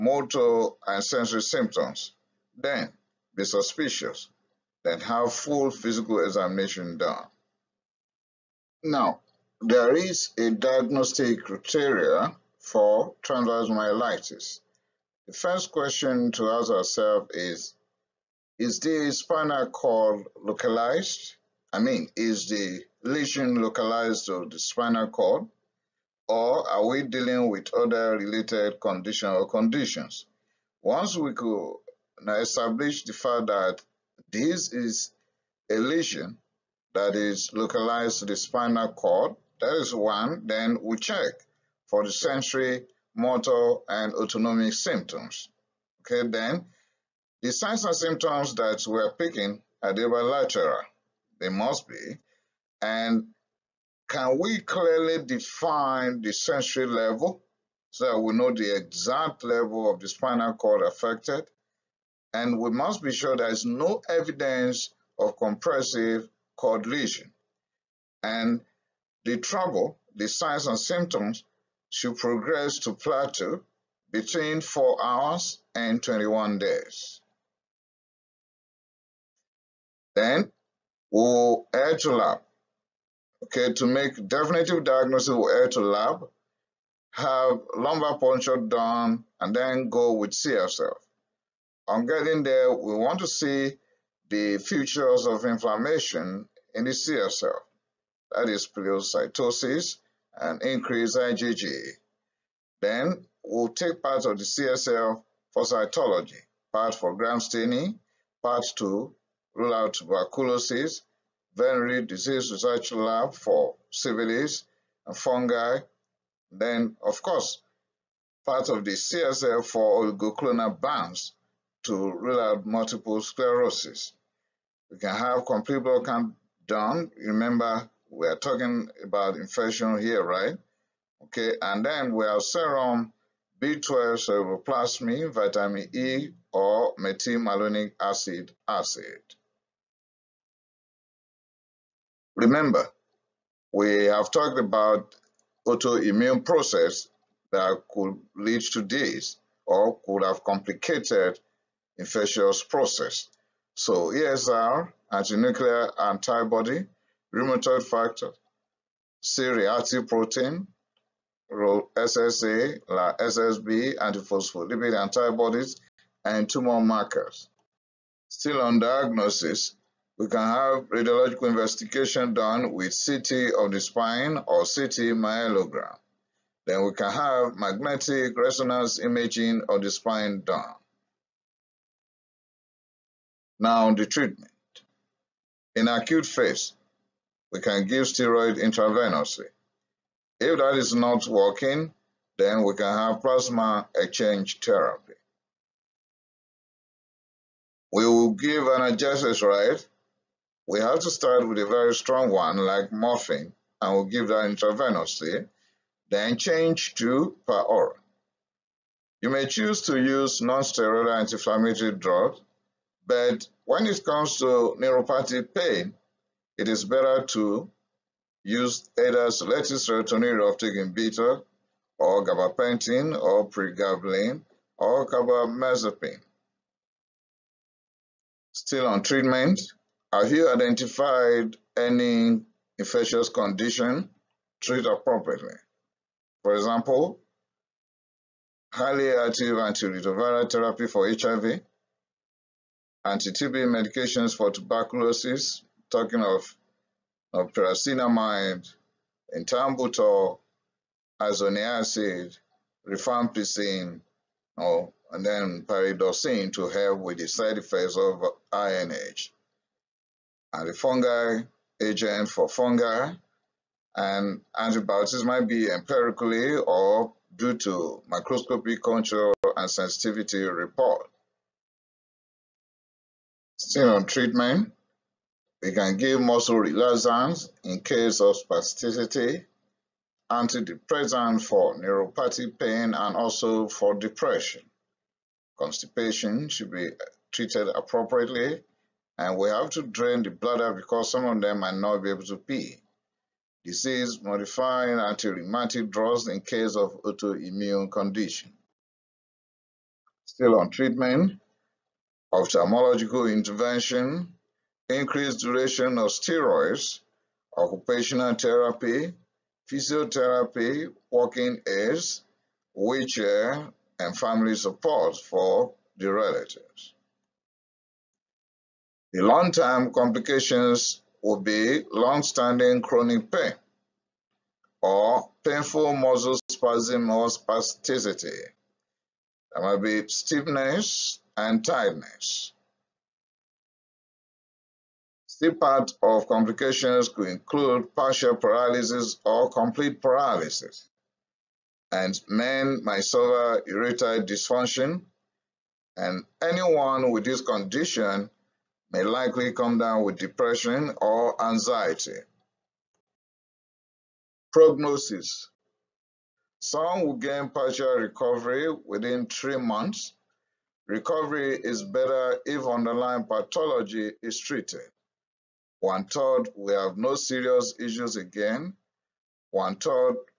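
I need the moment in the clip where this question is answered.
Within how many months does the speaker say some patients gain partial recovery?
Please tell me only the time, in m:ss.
5:59.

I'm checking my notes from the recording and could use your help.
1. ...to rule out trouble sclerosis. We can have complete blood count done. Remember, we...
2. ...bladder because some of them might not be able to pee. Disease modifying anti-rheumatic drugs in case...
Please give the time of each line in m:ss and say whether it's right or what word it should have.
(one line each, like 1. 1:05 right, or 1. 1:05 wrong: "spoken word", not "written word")
1. 2:01 wrong: "multiple", not "trouble"
2. 4:50 right.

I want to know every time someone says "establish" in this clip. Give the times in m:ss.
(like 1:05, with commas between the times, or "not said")
0:32.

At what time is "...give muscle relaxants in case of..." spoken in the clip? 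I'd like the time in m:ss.
4:35.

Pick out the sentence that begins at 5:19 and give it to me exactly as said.
The long-term complications would be long-standing chronic pain or painful muscle spasm or spasticity.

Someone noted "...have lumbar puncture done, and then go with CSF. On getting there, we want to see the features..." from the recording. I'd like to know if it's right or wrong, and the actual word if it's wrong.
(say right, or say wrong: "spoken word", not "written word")
right.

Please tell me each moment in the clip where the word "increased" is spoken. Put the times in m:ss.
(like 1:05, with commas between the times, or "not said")
1:40, 5:04.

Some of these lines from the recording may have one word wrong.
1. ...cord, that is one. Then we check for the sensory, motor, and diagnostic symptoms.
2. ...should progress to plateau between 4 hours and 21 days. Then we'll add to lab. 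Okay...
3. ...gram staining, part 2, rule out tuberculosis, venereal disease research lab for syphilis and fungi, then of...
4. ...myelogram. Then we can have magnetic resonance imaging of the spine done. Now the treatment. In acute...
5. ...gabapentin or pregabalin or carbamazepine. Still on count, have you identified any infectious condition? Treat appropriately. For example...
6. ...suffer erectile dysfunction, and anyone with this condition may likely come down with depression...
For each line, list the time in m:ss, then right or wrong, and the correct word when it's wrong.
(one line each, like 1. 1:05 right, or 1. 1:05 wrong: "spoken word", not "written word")
1. 0:38 wrong: "autonomic", not "diagnostic"
2. 1:11 right
3. 1:47 right
4. 2:55 right
5. 3:42 wrong: "treatment", not "count"
6. 5:43 right.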